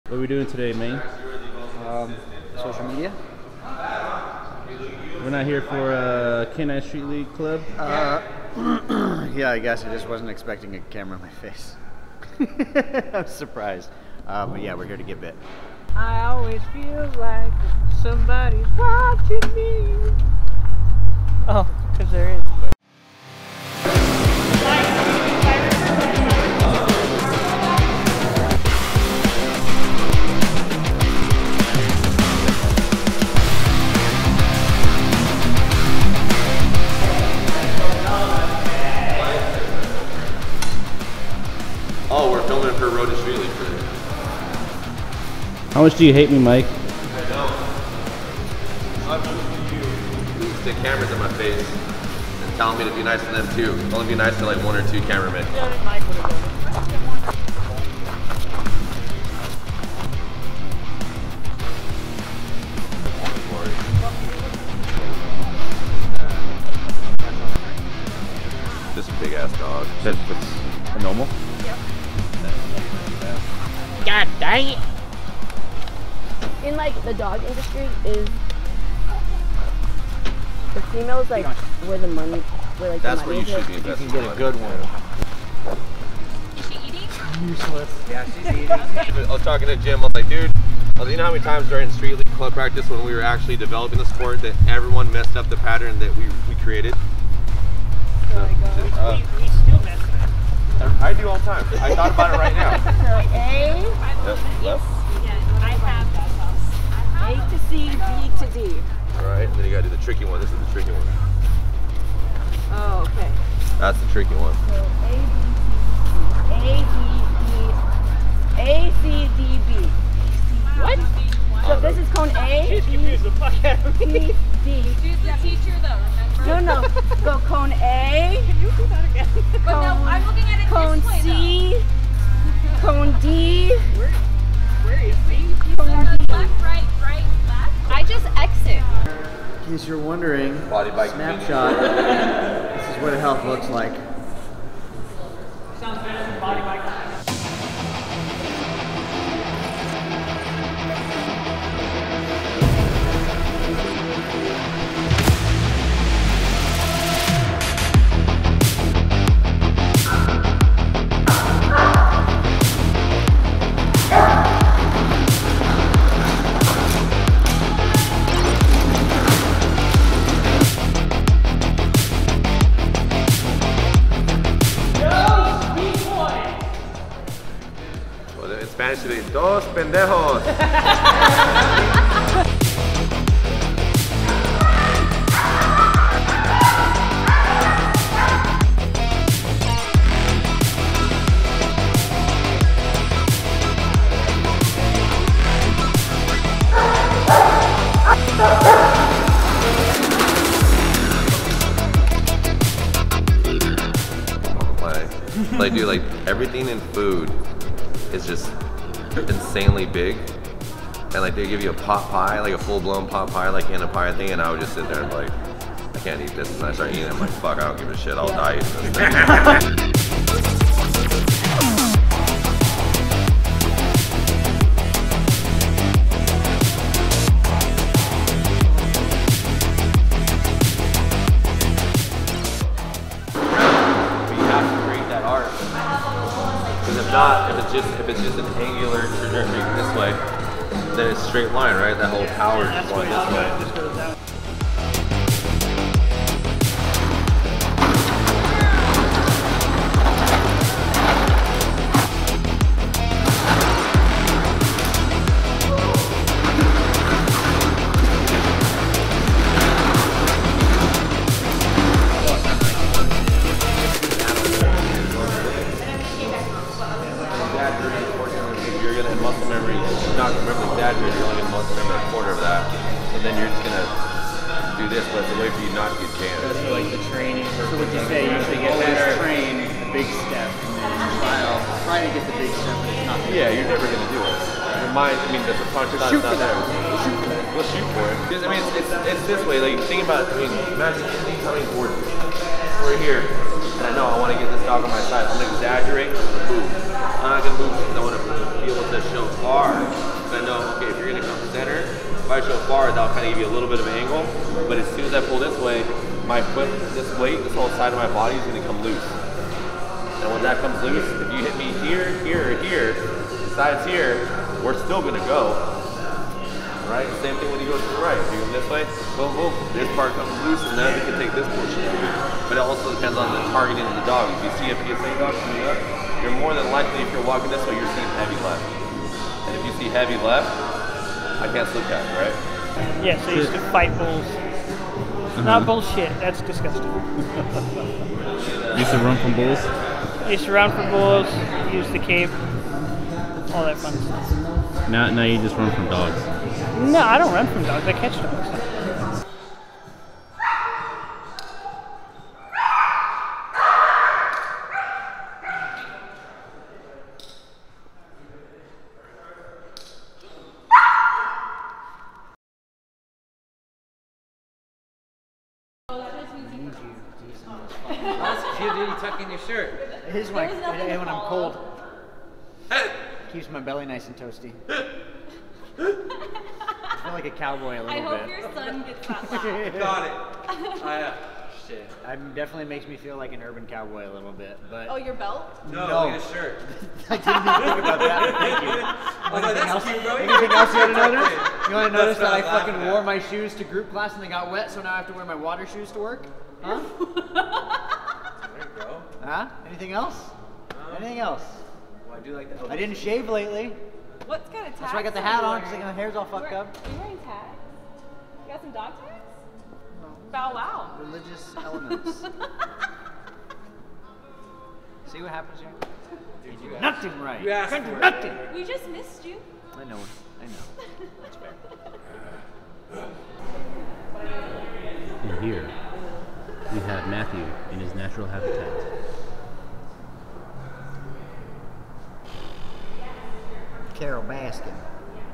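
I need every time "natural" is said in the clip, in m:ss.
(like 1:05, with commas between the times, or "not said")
7:07.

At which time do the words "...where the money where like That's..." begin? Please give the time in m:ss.
1:21.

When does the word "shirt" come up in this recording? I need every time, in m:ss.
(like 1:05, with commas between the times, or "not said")
6:09, 6:26.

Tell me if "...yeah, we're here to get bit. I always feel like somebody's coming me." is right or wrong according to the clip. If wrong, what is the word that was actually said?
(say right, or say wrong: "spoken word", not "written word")
wrong: "watching", not "coming".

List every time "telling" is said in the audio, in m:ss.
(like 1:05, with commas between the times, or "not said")
0:52.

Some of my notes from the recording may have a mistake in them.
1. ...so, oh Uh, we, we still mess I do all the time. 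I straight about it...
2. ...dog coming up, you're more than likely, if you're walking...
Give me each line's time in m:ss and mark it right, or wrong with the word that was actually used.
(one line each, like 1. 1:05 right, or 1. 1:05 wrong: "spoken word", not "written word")
1. 1:38 wrong: "thought", not "straight"
2. 5:25 right.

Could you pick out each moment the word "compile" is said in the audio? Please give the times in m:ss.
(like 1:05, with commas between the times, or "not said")
not said.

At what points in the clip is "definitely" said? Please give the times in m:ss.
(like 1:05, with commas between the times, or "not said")
6:22.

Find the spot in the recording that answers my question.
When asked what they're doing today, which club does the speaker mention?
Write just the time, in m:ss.
0:06.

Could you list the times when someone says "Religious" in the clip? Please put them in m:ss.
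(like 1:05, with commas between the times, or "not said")
6:51.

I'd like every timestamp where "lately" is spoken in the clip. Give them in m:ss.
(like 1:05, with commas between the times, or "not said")
6:43.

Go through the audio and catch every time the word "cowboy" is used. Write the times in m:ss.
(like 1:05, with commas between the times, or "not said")
6:17, 6:23.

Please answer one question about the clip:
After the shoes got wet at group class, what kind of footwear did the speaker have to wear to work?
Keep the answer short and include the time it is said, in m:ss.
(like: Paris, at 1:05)
water shoes, at 6:35.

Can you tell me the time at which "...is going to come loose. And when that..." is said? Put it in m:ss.
5:08.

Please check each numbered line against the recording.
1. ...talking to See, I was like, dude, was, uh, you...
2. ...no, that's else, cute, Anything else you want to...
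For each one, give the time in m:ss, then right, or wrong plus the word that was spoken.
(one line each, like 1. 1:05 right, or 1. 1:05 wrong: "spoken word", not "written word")
1. 1:29 wrong: "Jim", not "See"
2. 6:29 right.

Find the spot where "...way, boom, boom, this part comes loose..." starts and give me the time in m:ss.
5:18.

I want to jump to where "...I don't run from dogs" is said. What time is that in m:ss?
5:47.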